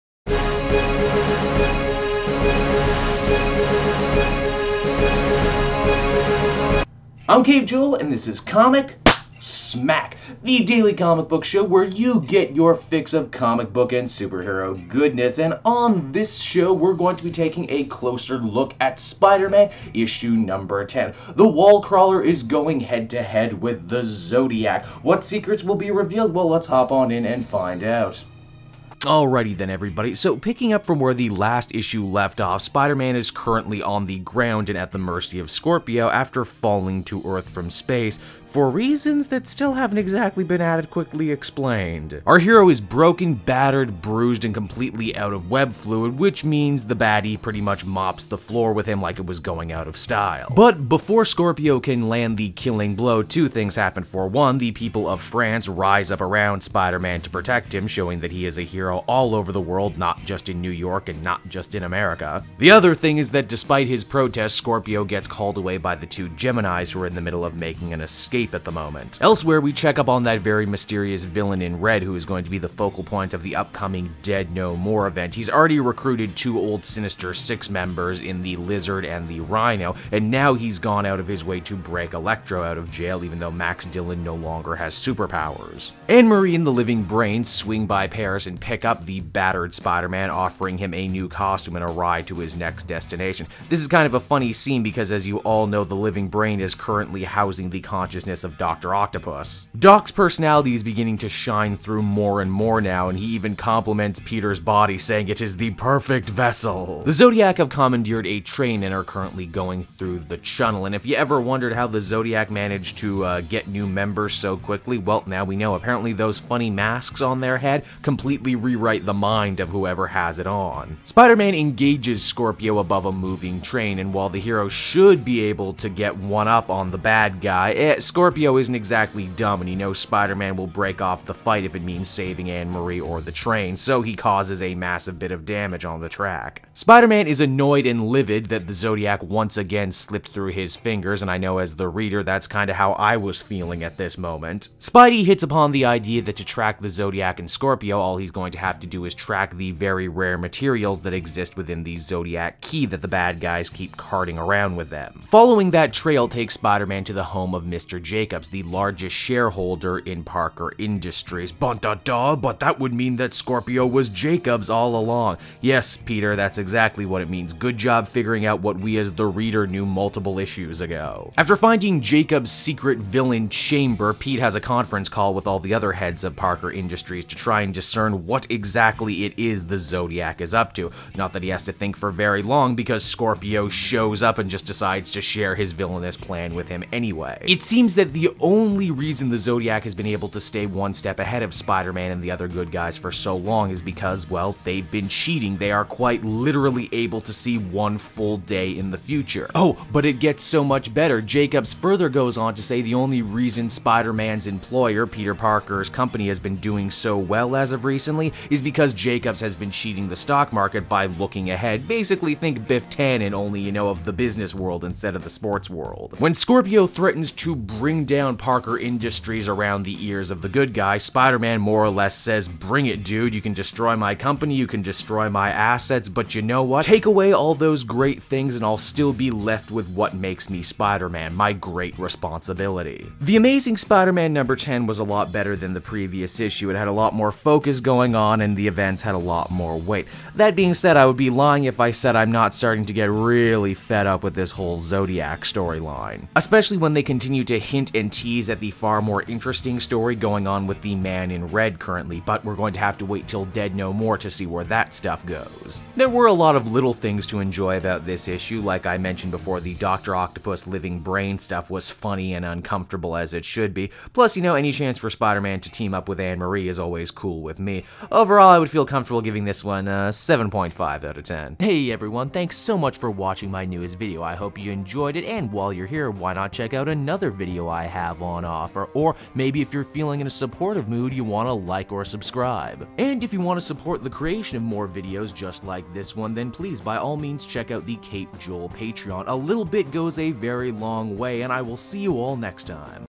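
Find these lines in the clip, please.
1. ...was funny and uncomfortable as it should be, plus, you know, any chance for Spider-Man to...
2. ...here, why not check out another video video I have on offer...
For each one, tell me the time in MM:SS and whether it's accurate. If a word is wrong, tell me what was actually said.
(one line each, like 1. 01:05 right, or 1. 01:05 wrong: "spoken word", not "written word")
1. 04:21 right
2. 04:35 right.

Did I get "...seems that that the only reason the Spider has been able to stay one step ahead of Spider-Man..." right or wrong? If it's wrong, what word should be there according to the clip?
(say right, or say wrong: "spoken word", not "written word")
wrong: "Zodiac", not "Spider".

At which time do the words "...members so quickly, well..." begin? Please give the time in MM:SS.
01:53.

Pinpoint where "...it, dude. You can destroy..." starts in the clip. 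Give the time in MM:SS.
03:42.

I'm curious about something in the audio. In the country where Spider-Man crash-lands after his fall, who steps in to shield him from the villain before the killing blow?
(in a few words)
The people of France.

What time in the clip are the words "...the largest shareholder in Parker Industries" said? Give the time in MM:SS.
02:38.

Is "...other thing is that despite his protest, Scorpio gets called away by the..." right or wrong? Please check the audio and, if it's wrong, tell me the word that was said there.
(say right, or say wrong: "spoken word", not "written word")
right.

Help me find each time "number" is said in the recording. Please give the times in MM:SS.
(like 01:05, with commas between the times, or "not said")
00:20, 03:54.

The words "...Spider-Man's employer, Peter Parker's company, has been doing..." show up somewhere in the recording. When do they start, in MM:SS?
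03:23.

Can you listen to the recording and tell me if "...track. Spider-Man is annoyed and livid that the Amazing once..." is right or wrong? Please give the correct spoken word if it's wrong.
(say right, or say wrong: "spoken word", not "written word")
wrong: "Zodiac", not "Amazing".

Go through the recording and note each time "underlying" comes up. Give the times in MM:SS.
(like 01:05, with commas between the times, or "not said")
not said.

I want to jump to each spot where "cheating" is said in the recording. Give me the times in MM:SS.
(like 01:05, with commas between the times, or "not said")
03:15, 03:29.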